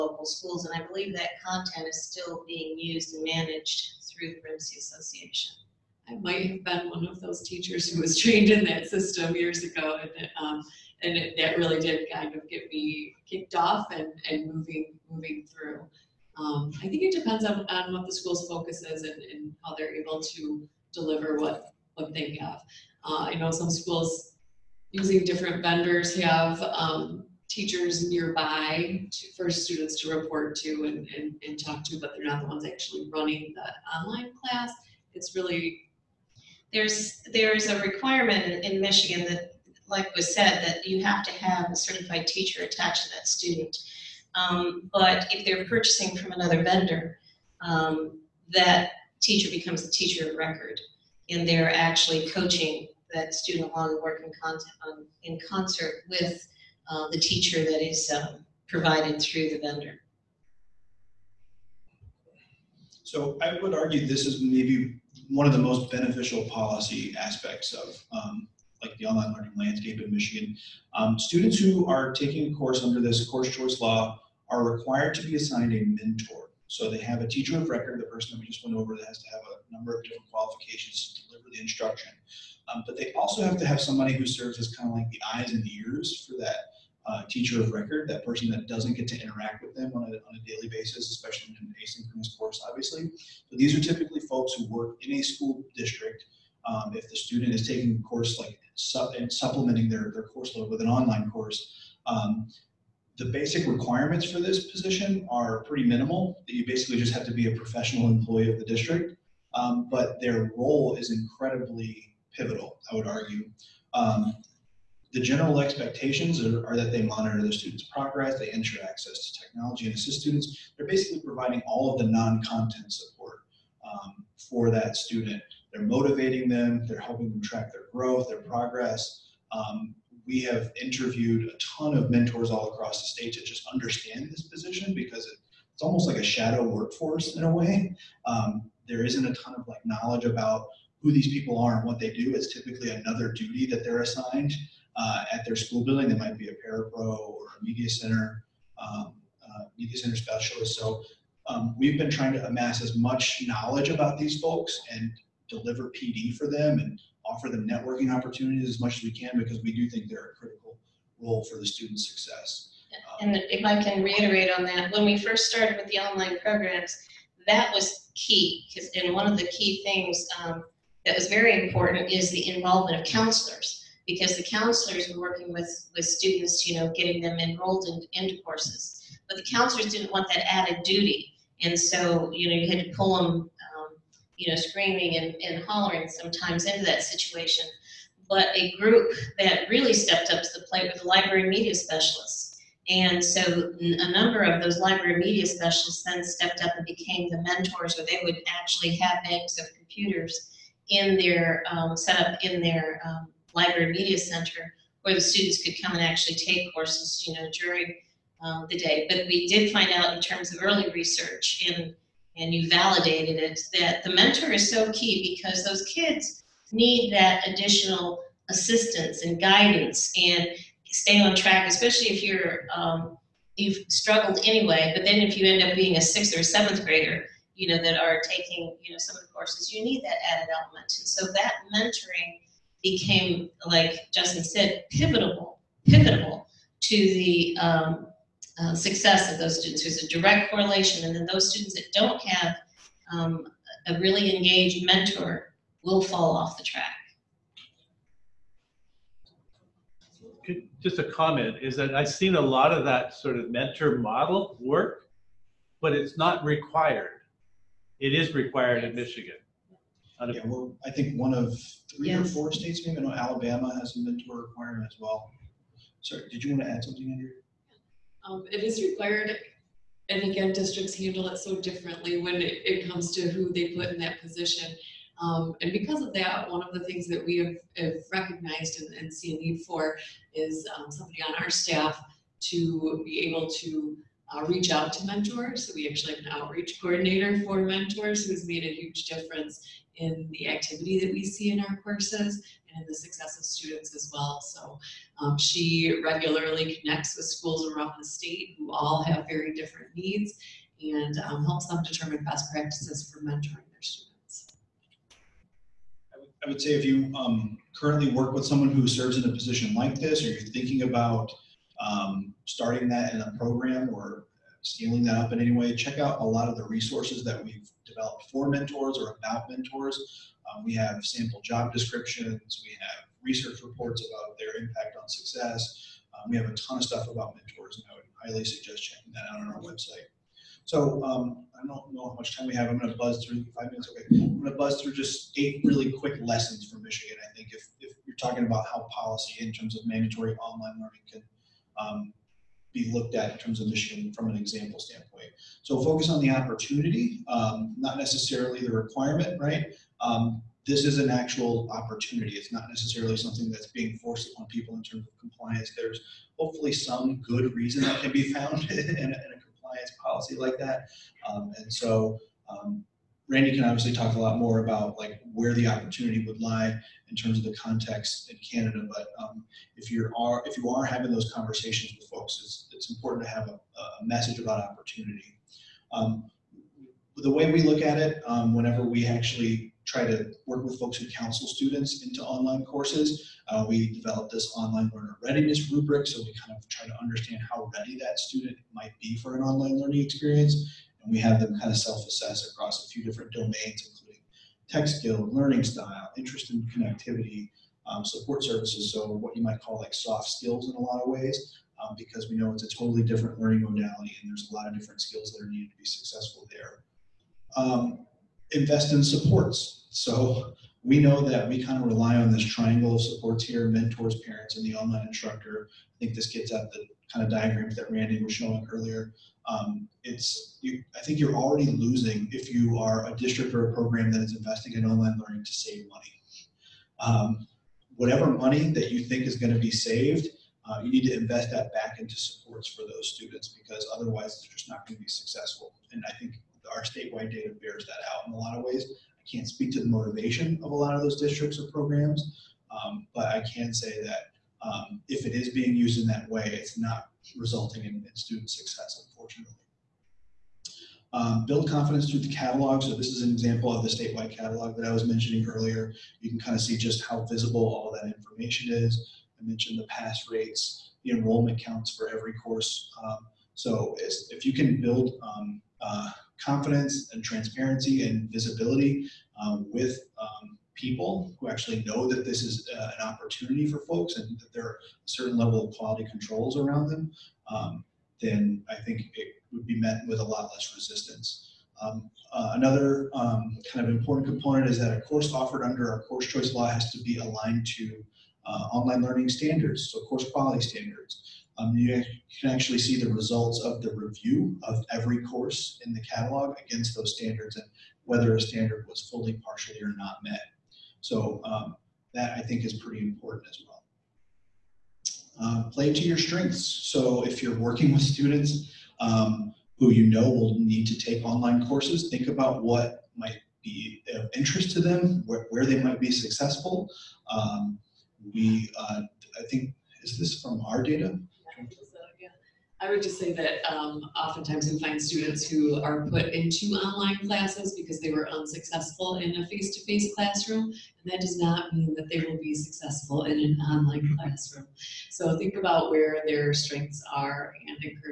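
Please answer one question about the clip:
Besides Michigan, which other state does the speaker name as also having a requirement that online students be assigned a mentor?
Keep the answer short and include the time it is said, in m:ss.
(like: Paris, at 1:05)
Alabama, at 4:23.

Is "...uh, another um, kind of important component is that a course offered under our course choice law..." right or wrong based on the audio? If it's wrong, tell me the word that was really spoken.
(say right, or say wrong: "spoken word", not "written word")
right.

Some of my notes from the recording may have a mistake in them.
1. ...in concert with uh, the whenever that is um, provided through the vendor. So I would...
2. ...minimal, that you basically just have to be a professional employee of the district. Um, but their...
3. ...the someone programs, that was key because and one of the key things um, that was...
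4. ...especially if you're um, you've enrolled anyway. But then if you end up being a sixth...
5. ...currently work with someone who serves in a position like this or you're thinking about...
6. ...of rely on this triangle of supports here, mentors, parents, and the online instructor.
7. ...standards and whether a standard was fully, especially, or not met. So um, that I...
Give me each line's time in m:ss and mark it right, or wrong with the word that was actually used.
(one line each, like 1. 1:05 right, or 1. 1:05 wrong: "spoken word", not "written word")
1. 0:55 wrong: "teacher", not "whenever"
2. 1:45 right
3. 2:45 wrong: "online", not "someone"
4. 3:41 wrong: "struggled", not "enrolled"
5. 5:07 right
6. 6:51 right
7. 8:17 wrong: "partially", not "especially".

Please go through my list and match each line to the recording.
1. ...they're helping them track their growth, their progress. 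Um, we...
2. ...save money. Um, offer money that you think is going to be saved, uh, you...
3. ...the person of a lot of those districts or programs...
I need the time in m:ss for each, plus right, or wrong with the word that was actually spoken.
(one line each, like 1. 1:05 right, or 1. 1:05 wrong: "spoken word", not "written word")
1. 2:06 right
2. 7:05 wrong: "whatever", not "offer"
3. 7:19 wrong: "motivation", not "person".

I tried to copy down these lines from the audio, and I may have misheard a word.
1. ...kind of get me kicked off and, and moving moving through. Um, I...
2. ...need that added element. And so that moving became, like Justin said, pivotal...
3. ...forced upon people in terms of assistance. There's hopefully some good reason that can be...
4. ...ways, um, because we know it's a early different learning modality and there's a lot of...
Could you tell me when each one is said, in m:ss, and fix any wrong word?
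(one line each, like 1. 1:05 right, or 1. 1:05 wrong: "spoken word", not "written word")
1. 0:12 right
2. 3:49 wrong: "mentoring", not "moving"
3. 5:53 wrong: "compliance", not "assistance"
4. 6:41 wrong: "totally", not "early".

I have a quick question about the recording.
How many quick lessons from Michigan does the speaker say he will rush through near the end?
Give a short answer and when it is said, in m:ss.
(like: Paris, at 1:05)
8, at 5:35.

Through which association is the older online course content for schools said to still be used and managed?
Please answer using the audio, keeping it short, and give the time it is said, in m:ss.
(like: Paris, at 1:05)
REMC Association, at 0:04.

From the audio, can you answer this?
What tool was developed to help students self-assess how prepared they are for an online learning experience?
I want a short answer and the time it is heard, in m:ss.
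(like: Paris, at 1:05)
online learner readiness rubric, at 6:24.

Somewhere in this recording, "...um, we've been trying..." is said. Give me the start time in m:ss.
2:31.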